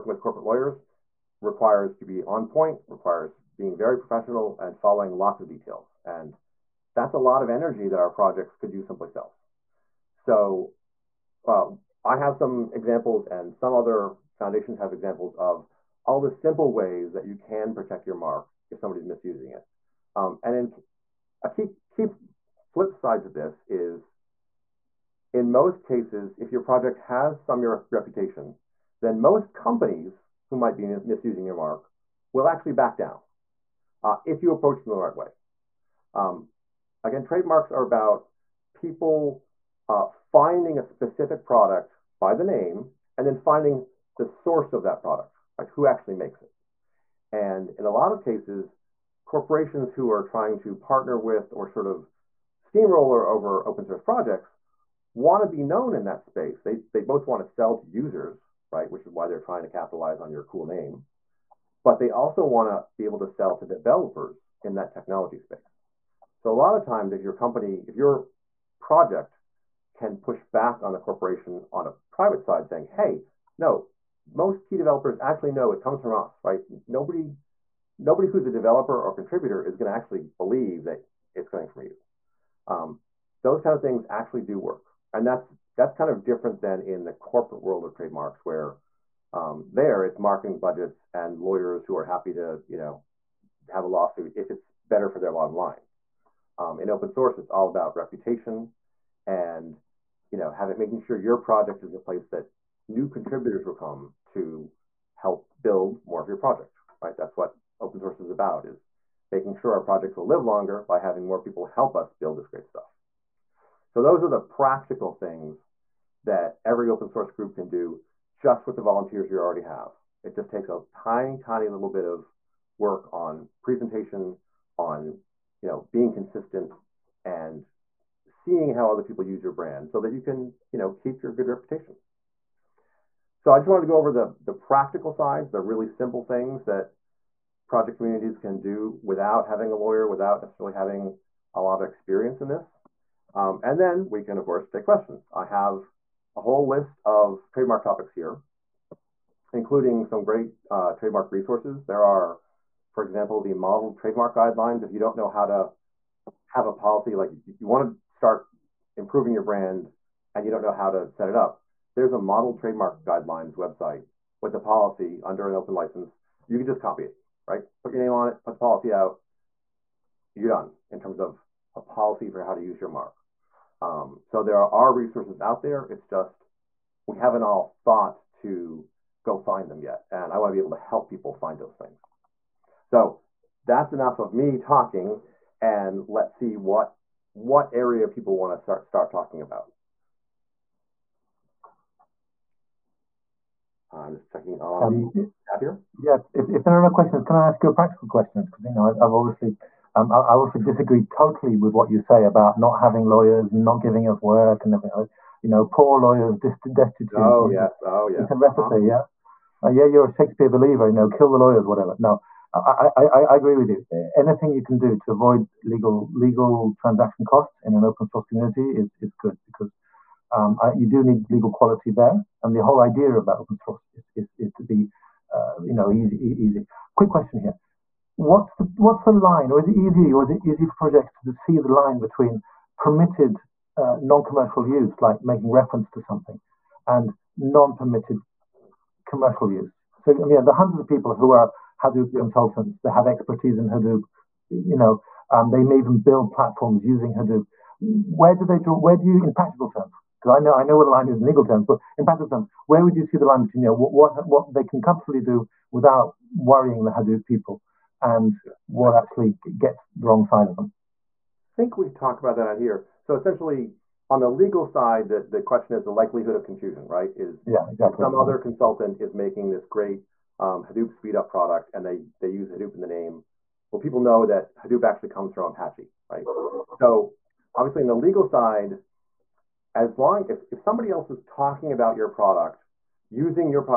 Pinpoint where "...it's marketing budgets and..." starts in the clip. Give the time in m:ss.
1:30.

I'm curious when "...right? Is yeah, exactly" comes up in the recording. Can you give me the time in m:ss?
4:26.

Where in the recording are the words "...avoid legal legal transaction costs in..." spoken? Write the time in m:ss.
3:35.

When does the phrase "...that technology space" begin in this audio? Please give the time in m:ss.
1:04.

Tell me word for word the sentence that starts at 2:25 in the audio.
I have a whole list of trademark topics here, including some great uh, trademark resources.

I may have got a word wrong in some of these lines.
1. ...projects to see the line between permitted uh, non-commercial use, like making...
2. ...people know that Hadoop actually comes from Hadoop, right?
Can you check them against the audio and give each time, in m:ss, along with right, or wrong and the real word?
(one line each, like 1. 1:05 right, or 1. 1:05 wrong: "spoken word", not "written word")
1. 3:50 right
2. 4:33 wrong: "Apache", not "Hadoop".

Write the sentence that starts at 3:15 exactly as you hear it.
Yeah, if, if, there are no questions, can I ask you a practical question?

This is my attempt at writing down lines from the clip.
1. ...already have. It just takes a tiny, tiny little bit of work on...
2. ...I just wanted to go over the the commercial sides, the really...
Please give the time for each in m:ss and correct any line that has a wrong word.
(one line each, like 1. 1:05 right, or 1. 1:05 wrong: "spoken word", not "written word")
1. 1:59 right
2. 2:13 wrong: "practical", not "commercial".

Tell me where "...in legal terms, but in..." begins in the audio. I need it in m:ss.
4:11.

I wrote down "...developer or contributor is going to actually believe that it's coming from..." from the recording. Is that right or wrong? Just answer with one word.
right.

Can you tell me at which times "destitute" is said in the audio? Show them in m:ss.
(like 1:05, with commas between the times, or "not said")
3:26.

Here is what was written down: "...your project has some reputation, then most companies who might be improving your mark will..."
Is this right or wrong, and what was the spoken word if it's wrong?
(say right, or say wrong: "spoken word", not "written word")
wrong: "misusing", not "improving".